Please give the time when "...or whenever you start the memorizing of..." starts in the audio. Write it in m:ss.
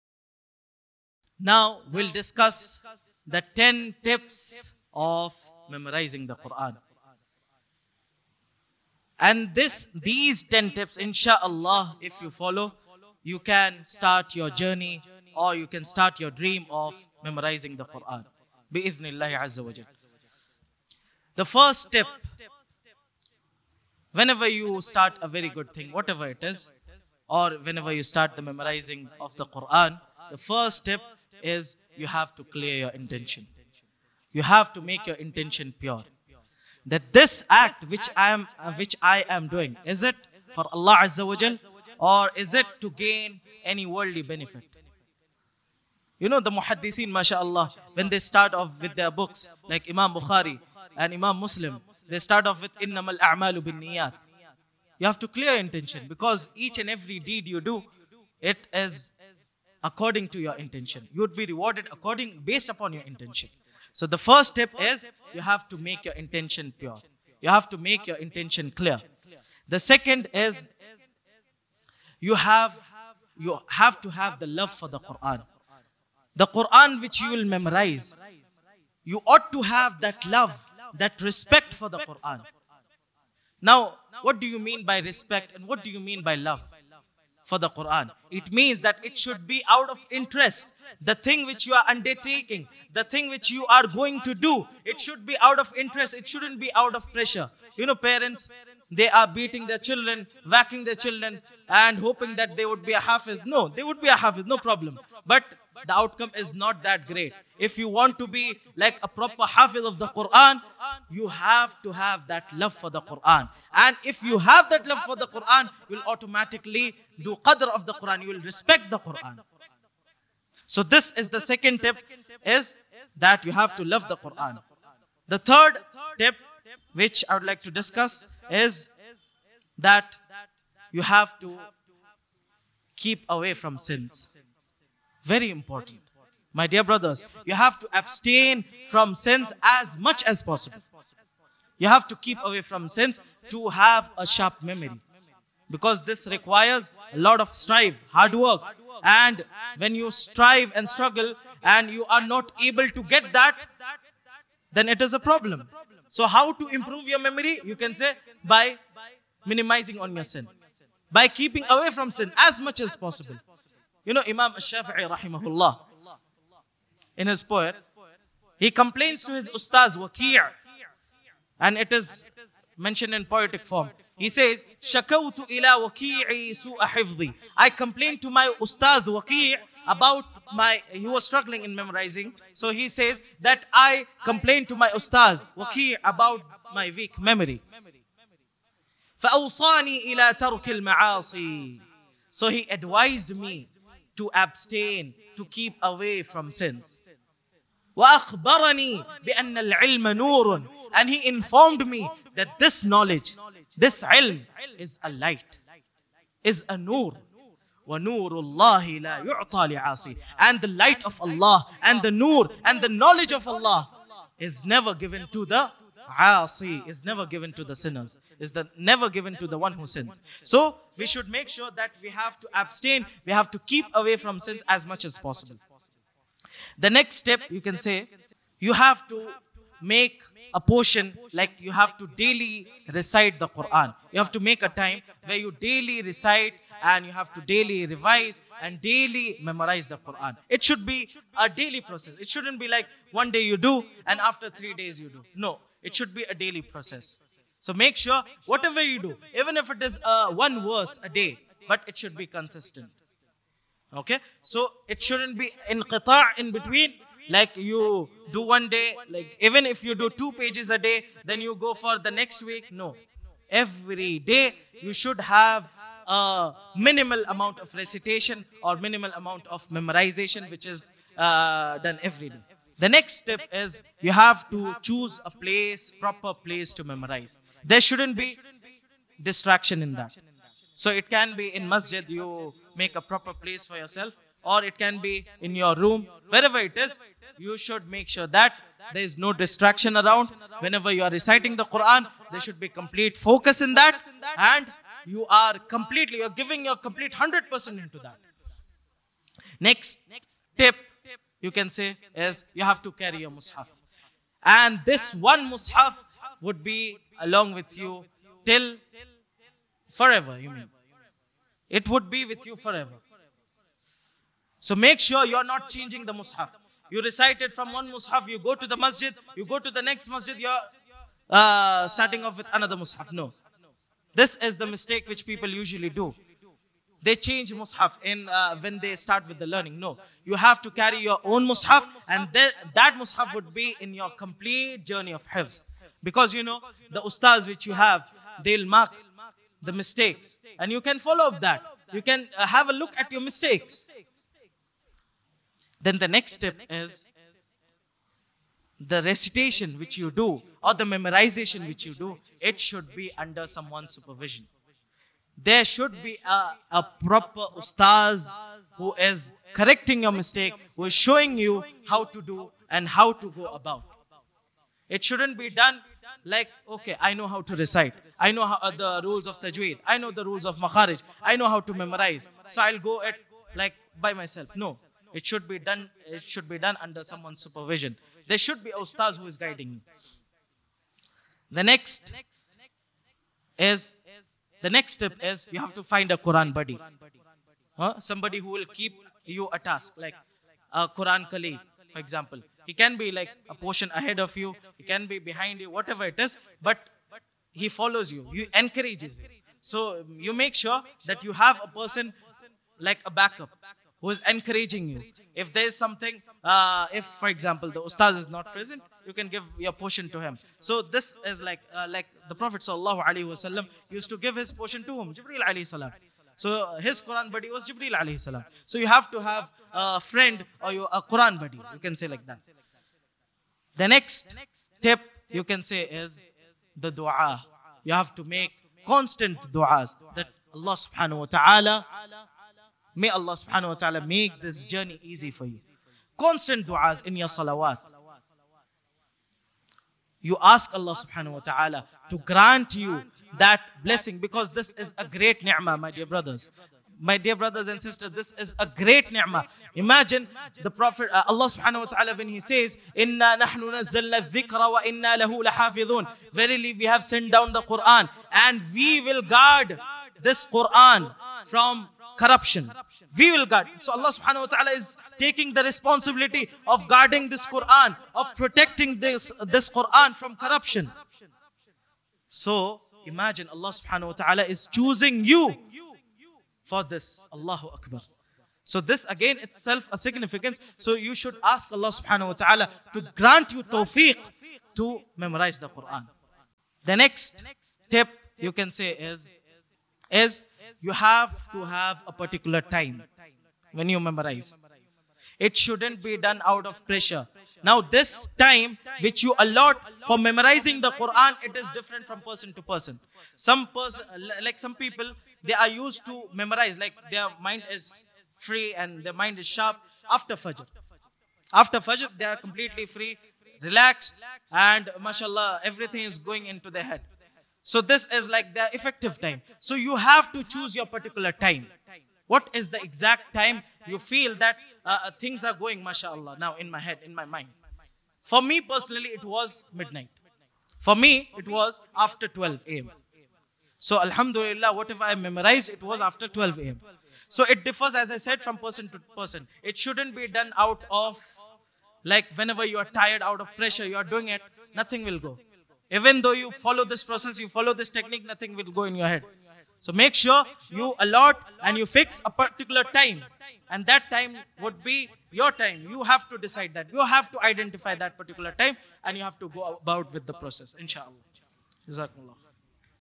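0:27.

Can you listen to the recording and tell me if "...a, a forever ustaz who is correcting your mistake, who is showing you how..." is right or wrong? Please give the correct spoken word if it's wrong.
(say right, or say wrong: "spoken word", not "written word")
wrong: "proper", not "forever".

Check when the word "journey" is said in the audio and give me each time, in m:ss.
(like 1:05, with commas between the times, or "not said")
0:14, 5:34, 7:14.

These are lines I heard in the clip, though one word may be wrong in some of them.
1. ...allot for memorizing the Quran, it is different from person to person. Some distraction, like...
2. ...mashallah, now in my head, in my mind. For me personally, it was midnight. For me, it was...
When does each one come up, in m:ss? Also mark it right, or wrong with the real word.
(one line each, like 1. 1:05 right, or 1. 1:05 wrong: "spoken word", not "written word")
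1. 8:19 wrong: "person", not "distraction"
2. 8:45 right.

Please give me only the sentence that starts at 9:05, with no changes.
Even though you follow this process, you follow this technique, nothing will go in your head.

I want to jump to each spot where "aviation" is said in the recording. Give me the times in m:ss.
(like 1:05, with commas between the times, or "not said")
not said.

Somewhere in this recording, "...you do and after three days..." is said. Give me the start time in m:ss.
4:03.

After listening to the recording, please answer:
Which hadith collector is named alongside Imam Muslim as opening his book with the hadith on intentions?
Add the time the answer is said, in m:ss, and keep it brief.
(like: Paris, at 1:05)
Imam Bukhari, at 0:49.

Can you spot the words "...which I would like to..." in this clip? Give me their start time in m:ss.
2:06.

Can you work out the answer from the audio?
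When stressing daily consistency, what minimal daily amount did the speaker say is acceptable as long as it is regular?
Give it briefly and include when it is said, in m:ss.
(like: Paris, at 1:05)
One verse a day, at 4:10.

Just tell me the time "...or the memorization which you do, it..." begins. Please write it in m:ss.
5:50.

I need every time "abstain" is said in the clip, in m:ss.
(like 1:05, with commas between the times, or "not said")
2:17, 3:14, 3:42.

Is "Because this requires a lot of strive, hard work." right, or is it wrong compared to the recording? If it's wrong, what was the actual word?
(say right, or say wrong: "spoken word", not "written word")
right.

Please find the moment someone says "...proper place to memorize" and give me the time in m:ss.
4:35.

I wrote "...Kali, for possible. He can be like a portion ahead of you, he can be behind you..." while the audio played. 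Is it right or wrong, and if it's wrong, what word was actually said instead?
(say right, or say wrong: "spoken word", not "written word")
wrong: "example", not "possible".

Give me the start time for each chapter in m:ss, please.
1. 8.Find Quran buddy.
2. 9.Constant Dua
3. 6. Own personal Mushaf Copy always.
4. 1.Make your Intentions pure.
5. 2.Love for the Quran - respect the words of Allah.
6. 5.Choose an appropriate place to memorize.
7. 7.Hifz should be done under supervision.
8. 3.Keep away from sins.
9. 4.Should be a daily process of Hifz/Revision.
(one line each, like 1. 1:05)
1. 6:23
2. 7:03
3. 5:00
4. 0:22
5. 1:09
6. 4:35
7. 5:48
8. 2:05
9. 3:46.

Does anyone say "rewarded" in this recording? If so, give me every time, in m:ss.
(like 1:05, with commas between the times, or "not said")
1:01.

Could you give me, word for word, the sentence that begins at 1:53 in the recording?
And if you have that love for the Quran, you'll automatically do qadr of the Quran.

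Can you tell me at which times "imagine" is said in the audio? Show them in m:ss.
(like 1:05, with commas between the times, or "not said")
7:29, 7:53.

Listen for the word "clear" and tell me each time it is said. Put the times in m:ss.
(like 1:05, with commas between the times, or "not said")
0:32, 0:55, 1:08.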